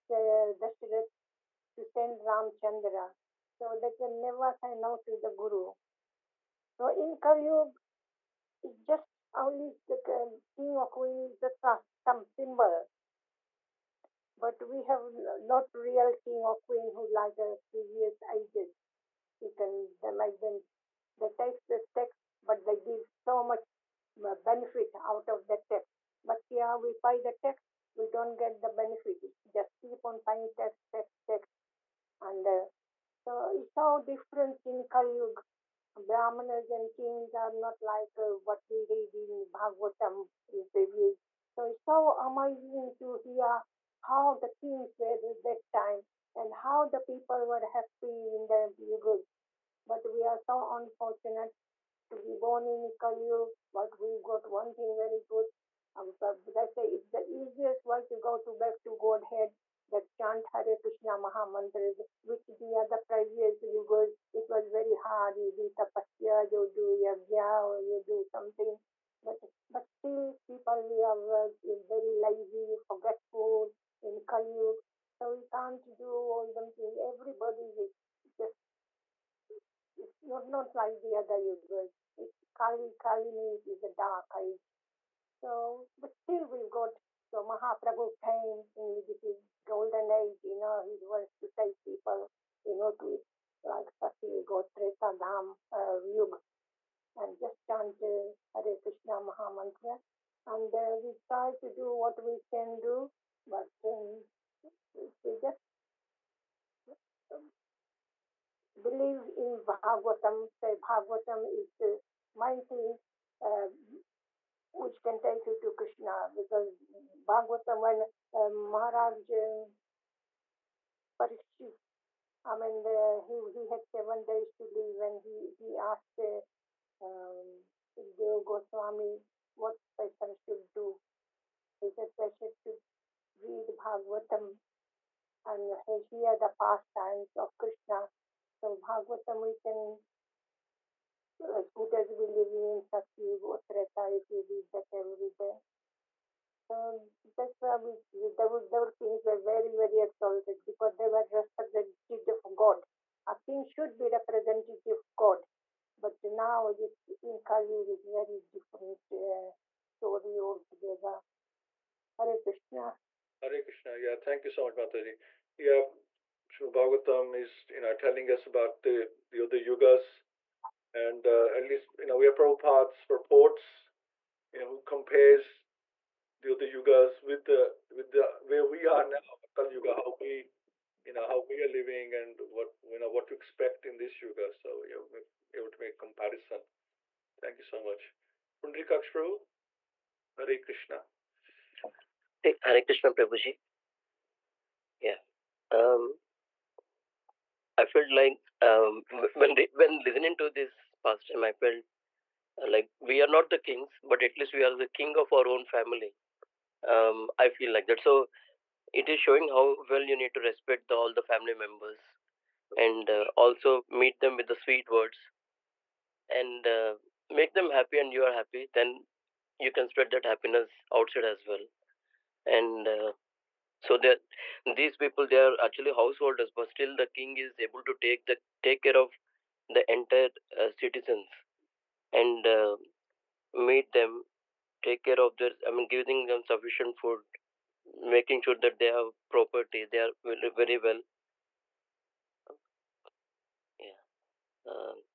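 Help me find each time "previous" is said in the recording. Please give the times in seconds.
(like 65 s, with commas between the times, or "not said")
17 s, 40 s, 63 s.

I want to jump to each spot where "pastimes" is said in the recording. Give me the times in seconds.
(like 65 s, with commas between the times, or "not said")
136 s, 201 s.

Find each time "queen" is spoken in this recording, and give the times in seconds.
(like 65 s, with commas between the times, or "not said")
10 s, 16 s.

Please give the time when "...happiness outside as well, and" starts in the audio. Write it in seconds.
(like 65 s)
220 s.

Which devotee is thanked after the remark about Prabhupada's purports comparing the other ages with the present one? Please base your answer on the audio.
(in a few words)
Pundrikaksh Prabhu.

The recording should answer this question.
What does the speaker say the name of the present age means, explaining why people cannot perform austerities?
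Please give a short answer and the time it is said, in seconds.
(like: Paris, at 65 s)
dark age, at 83 s.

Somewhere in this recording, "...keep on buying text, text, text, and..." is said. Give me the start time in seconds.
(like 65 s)
29 s.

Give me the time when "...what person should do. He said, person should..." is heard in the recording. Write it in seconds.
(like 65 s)
129 s.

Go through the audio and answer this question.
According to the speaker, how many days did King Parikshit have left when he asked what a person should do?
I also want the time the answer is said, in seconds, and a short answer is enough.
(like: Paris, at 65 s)
7, at 123 s.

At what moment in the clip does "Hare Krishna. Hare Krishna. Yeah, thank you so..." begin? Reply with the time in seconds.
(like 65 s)
162 s.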